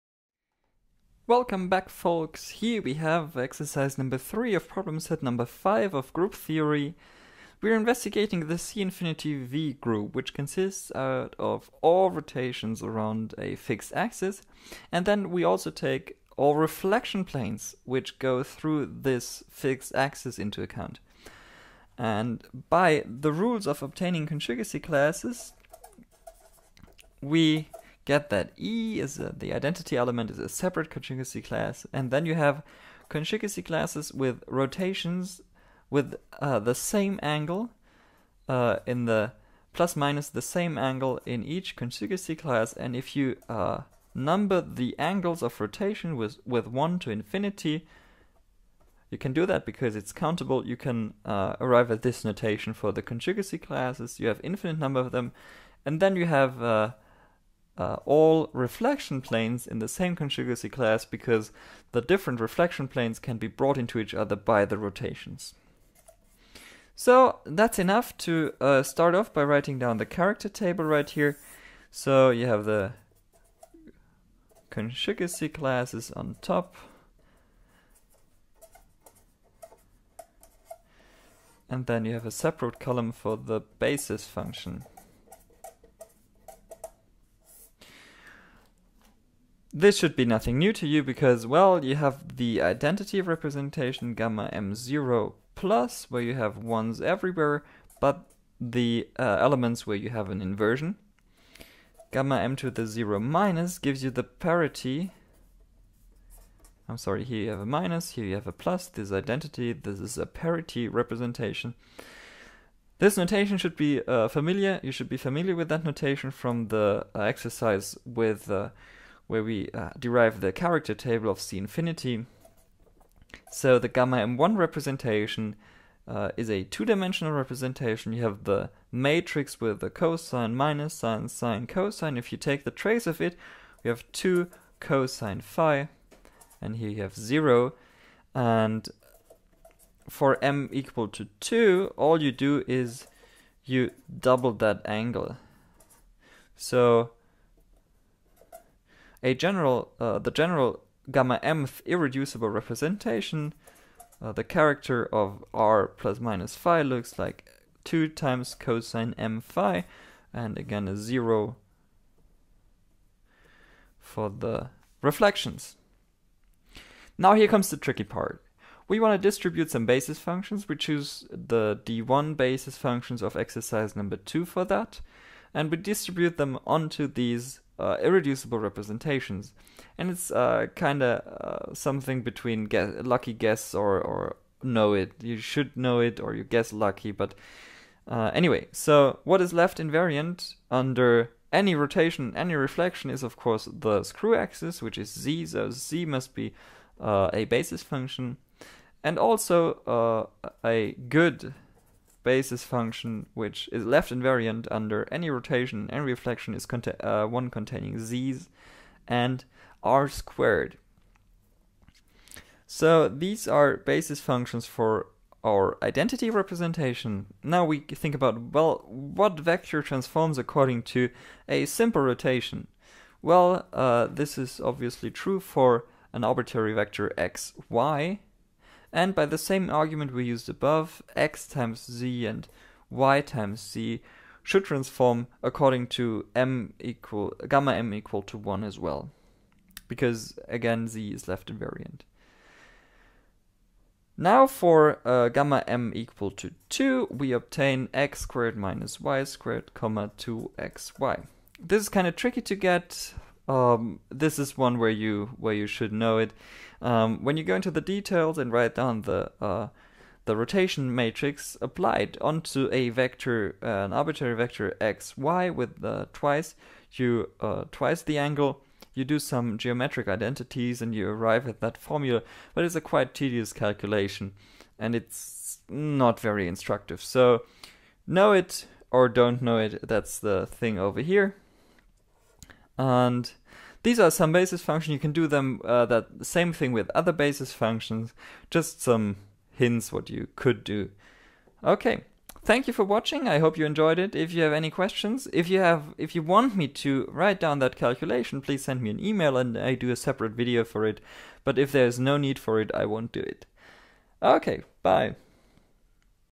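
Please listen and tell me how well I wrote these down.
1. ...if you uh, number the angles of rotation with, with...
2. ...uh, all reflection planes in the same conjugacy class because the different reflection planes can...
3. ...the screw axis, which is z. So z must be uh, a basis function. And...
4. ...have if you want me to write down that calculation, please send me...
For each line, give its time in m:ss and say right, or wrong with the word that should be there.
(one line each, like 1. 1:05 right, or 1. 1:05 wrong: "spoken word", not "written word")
1. 0:42 right
2. 0:57 right
3. 3:13 right
4. 4:55 right.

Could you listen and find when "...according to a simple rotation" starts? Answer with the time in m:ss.
3:40.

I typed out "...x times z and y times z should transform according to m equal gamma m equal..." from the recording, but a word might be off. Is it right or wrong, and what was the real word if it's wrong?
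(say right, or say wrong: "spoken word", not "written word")
right.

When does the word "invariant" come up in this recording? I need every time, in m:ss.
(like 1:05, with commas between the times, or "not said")
3:09, 3:24, 4:01.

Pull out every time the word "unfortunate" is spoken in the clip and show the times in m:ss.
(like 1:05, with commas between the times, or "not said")
not said.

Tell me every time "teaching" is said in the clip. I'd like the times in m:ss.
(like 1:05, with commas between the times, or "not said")
not said.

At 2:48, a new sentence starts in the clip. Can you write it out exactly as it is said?
We want to distribute some basis functions.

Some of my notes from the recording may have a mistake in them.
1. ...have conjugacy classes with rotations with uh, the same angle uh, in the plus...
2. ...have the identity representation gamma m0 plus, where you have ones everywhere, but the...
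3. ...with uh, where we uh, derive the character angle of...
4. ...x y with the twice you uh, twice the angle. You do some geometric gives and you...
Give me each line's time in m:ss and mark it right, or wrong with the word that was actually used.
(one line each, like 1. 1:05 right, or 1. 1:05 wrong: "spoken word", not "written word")
1. 0:32 right
2. 1:31 right
3. 1:58 wrong: "table", not "angle"
4. 4:24 wrong: "identities", not "gives".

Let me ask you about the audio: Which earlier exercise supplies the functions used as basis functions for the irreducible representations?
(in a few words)
exercise number 2.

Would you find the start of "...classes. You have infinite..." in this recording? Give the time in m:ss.
0:53.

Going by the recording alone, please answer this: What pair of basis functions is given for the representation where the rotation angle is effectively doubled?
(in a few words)
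x squared minus y squared, 2xy.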